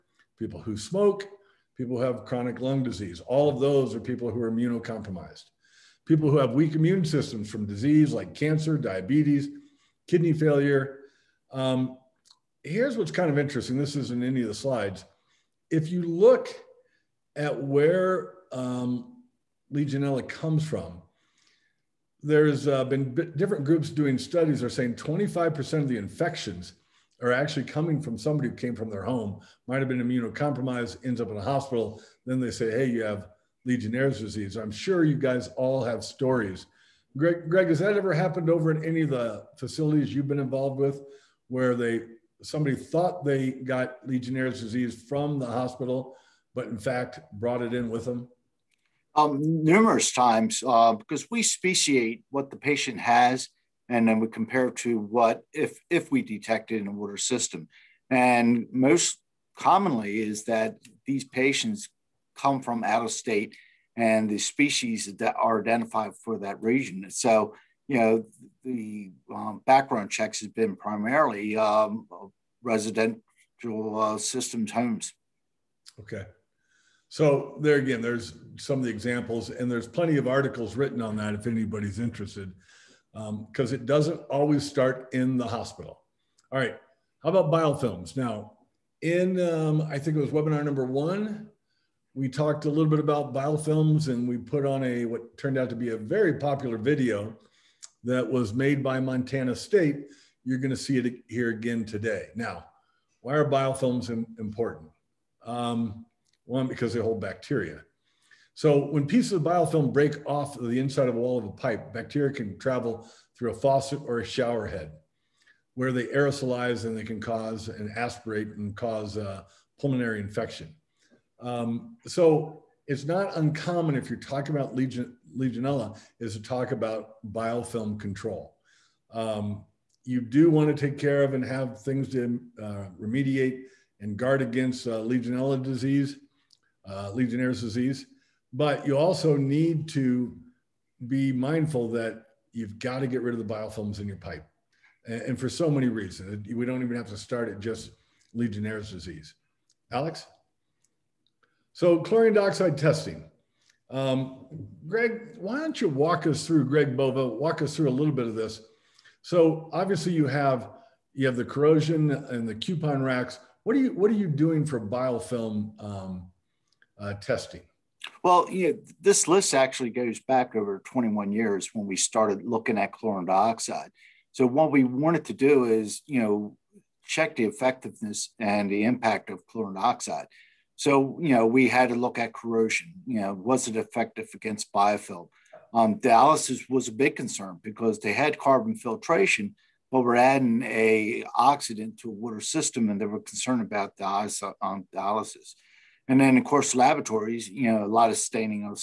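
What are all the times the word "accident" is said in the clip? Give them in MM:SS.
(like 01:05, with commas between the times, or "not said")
not said.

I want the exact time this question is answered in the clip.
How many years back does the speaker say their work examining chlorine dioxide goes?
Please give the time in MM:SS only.
02:50.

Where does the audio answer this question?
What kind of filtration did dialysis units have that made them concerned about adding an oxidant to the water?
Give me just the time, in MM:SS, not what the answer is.
03:08.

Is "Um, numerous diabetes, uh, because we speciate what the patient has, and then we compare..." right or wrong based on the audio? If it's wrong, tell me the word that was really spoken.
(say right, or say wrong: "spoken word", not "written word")
wrong: "times", not "diabetes".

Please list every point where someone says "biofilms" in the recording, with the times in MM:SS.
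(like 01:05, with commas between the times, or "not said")
01:27, 01:33, 01:43, 01:49, 02:07, 02:23, 02:44, 03:04.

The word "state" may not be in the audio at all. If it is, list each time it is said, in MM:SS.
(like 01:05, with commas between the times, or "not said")
01:03, 01:39.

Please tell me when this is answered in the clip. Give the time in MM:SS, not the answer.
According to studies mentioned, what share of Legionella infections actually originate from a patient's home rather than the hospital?
00:24.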